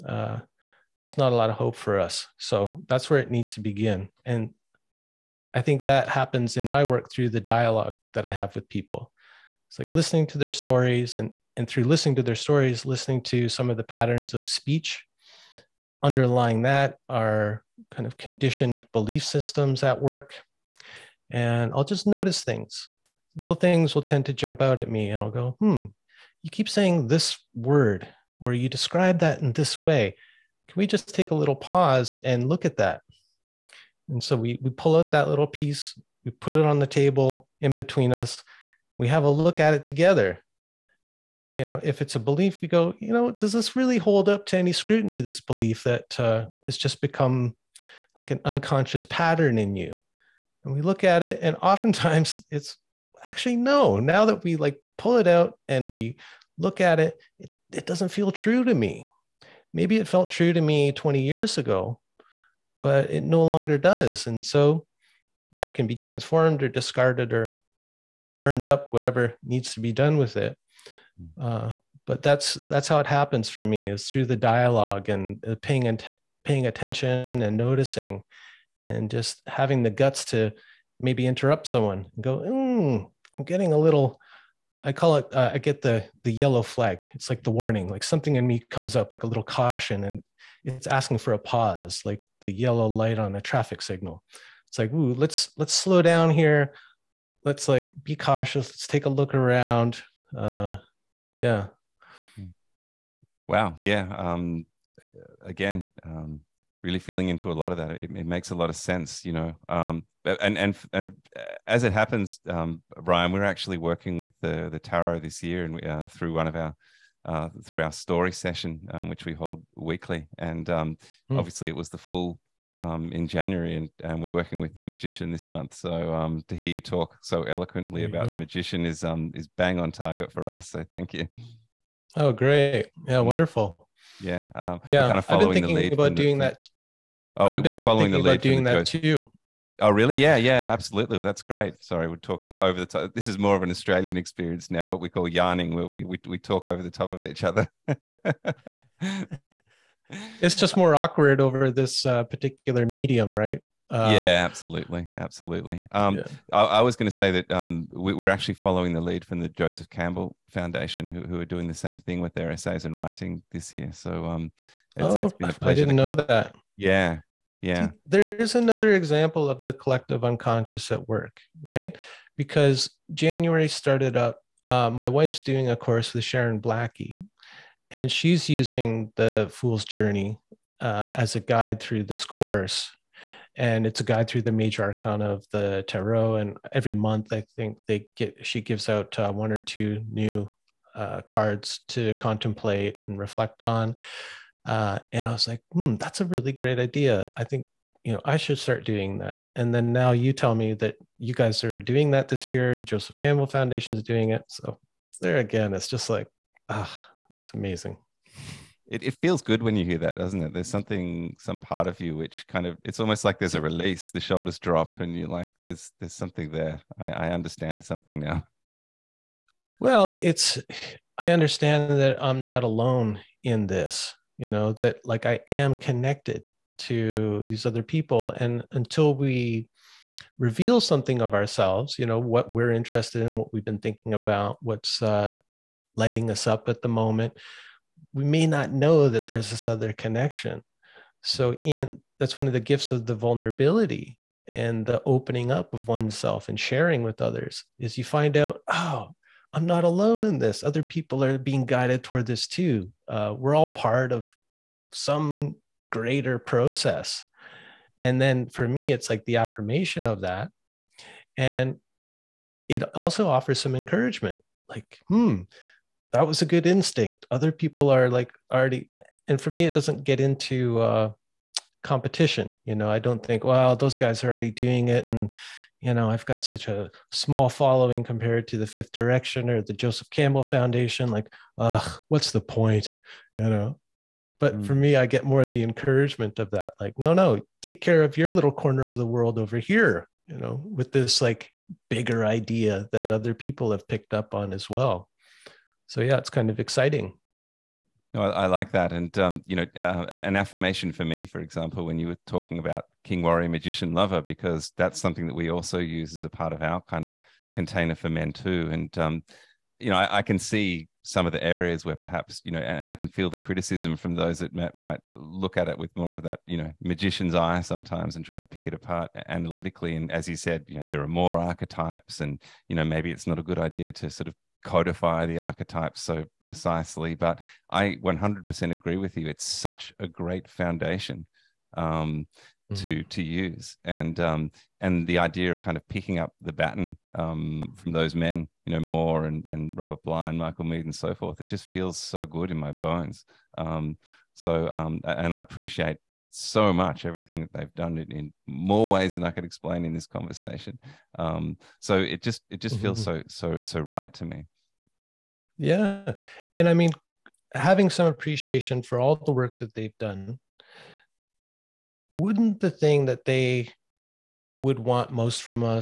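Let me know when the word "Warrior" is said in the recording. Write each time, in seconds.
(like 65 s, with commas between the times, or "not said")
303 s.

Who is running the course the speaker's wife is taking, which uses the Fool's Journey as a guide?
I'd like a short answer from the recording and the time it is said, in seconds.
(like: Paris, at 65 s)
Sharon Blackie, at 176 s.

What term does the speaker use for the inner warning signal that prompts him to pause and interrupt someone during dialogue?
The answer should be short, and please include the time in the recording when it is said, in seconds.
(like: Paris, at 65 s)
yellow flag, at 86 s.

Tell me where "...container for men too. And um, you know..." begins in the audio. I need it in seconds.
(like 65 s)
307 s.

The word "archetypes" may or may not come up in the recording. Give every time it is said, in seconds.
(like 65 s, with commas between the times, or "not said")
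321 s, 325 s.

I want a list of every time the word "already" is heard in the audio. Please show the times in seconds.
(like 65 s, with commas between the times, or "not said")
268 s, 274 s.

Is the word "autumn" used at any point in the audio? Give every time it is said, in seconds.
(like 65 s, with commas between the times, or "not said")
not said.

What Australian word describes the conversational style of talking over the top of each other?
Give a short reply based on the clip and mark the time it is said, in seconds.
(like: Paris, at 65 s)
yarning, at 145 s.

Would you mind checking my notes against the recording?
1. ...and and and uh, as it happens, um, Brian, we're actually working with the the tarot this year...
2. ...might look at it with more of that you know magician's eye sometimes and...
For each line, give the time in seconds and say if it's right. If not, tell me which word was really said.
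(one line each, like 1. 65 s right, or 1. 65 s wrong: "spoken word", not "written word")
1. 110 s right
2. 314 s right.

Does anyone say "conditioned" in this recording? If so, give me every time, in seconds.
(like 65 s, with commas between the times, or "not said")
18 s.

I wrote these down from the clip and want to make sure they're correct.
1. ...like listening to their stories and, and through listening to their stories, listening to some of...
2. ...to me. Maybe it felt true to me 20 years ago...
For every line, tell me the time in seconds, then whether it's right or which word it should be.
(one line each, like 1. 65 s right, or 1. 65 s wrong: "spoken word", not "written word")
1. 9 s right
2. 58 s right.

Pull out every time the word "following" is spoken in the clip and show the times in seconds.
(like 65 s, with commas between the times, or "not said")
137 s, 158 s, 277 s.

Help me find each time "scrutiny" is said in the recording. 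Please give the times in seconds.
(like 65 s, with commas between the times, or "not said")
44 s.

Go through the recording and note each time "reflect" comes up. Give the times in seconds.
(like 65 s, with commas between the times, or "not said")
193 s.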